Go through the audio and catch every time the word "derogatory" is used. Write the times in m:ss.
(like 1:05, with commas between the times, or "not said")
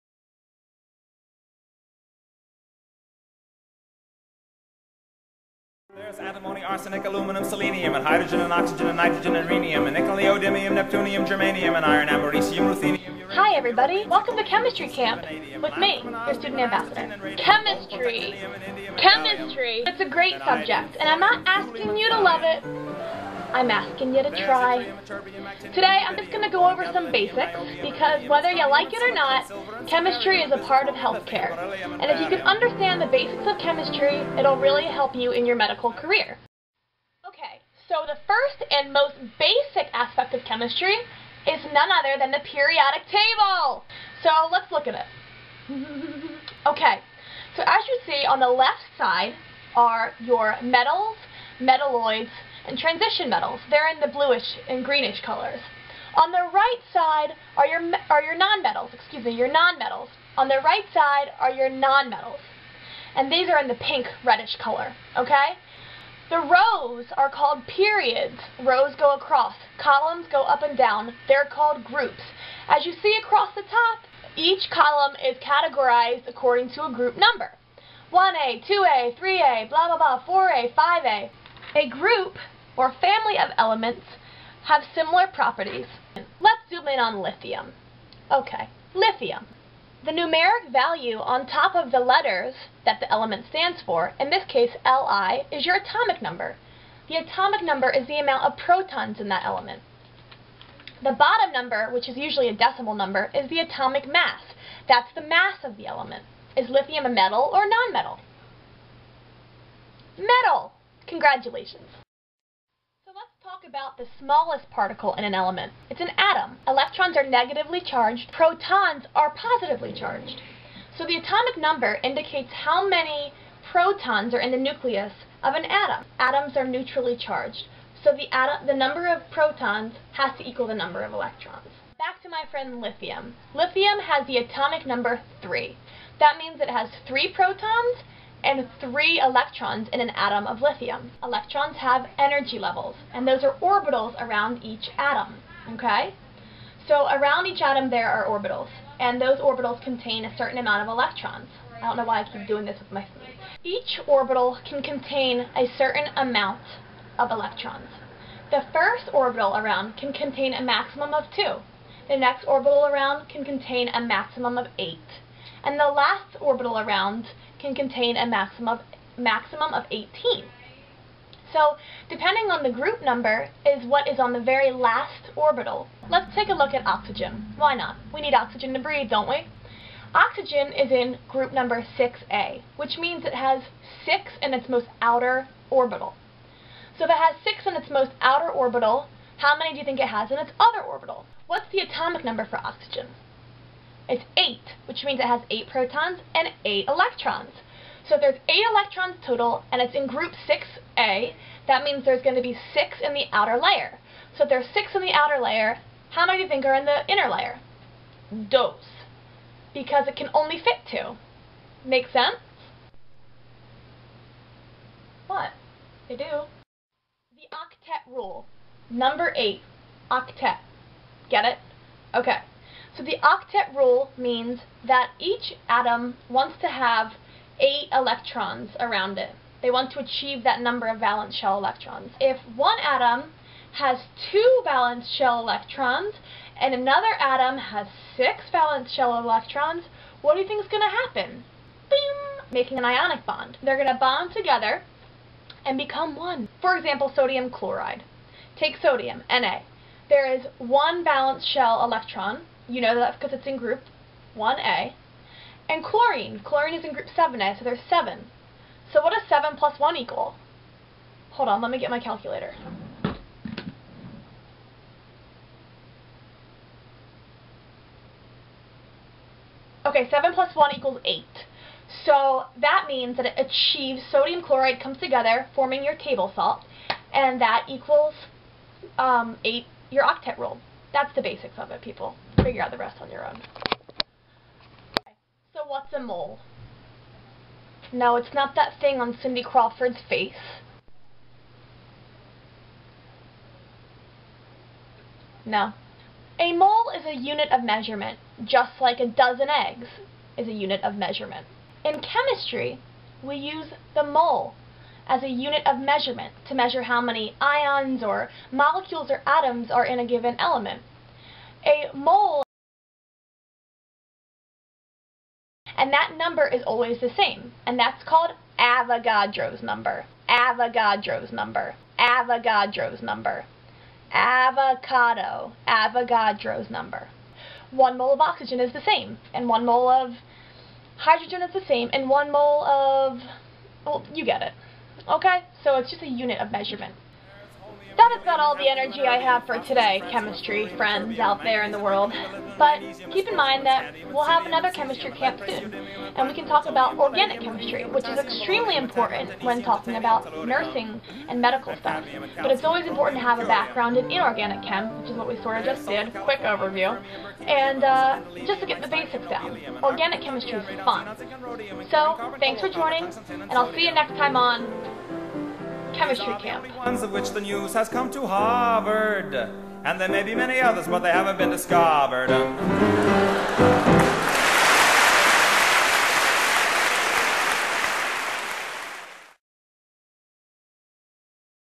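not said.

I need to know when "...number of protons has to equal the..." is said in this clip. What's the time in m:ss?
2:08.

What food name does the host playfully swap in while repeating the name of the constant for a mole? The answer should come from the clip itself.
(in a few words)
Avocado.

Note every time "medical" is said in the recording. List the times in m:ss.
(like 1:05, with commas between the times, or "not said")
0:35, 5:51.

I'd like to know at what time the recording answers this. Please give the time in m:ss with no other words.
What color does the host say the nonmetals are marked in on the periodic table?
1:03.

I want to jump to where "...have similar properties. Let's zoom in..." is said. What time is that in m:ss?
1:24.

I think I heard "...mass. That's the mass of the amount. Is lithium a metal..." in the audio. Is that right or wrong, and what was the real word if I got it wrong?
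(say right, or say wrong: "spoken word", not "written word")
wrong: "element", not "amount".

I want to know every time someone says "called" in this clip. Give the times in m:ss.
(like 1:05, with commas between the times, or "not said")
1:07, 1:11, 5:18.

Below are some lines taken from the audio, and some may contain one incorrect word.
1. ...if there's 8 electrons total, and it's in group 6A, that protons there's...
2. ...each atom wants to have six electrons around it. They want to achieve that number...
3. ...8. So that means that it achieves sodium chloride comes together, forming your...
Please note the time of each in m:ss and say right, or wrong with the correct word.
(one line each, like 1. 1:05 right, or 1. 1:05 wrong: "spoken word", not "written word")
1. 3:18 wrong: "means", not "protons"
2. 3:45 wrong: "eight", not "six"
3. 4:31 right.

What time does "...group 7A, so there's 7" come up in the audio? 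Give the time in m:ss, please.
4:16.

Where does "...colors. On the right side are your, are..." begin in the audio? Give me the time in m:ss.
0:55.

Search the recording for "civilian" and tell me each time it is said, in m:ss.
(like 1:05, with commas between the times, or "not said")
not said.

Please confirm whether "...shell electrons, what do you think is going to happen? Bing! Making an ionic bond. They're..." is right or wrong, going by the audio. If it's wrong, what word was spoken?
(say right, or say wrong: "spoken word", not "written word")
right.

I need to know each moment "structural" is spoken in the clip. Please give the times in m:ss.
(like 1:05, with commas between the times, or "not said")
not said.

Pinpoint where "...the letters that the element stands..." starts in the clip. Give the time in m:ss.
1:31.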